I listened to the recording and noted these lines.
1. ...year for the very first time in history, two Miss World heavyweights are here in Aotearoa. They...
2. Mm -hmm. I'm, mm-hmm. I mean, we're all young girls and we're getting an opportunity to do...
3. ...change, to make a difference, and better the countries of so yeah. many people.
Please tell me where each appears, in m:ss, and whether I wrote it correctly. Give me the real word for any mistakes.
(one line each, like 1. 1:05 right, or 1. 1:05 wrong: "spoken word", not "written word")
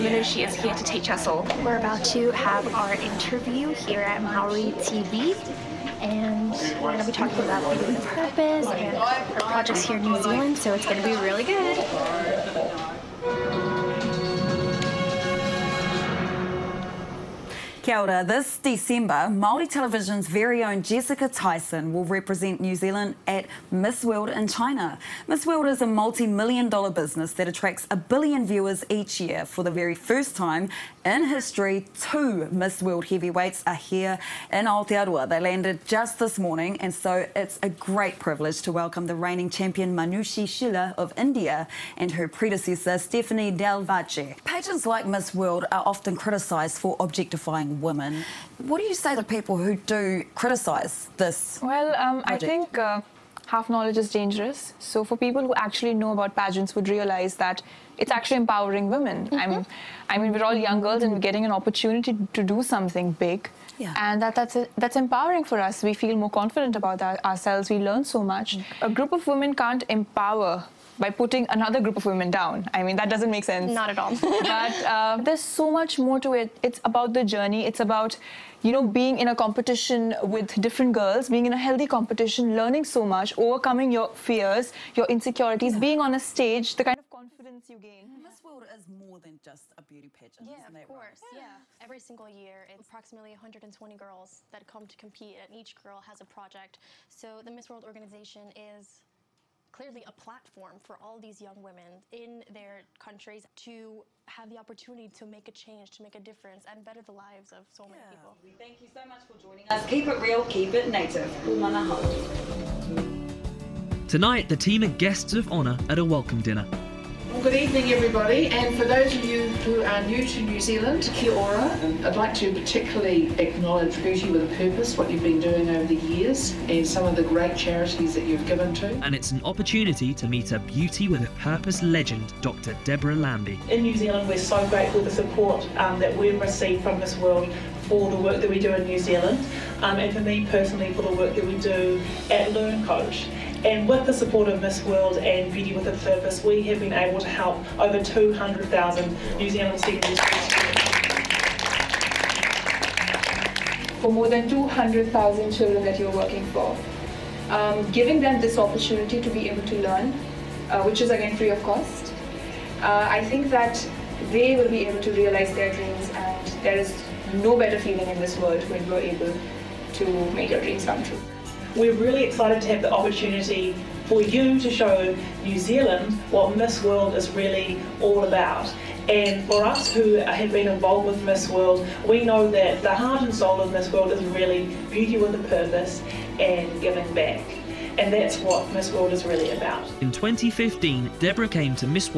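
1. 0:29 right
2. 0:59 right
3. 1:45 wrong: "lives", not "countries".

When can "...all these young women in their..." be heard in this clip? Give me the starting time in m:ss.
1:41.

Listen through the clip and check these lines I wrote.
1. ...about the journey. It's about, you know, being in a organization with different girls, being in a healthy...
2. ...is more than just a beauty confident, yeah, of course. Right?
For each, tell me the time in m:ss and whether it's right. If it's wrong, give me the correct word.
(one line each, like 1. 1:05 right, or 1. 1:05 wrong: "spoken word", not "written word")
1. 1:16 wrong: "competition", not "organization"
2. 1:28 wrong: "pageant", not "confident".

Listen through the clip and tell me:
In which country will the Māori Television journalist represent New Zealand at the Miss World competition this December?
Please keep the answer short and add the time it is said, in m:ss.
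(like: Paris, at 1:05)
China, at 0:24.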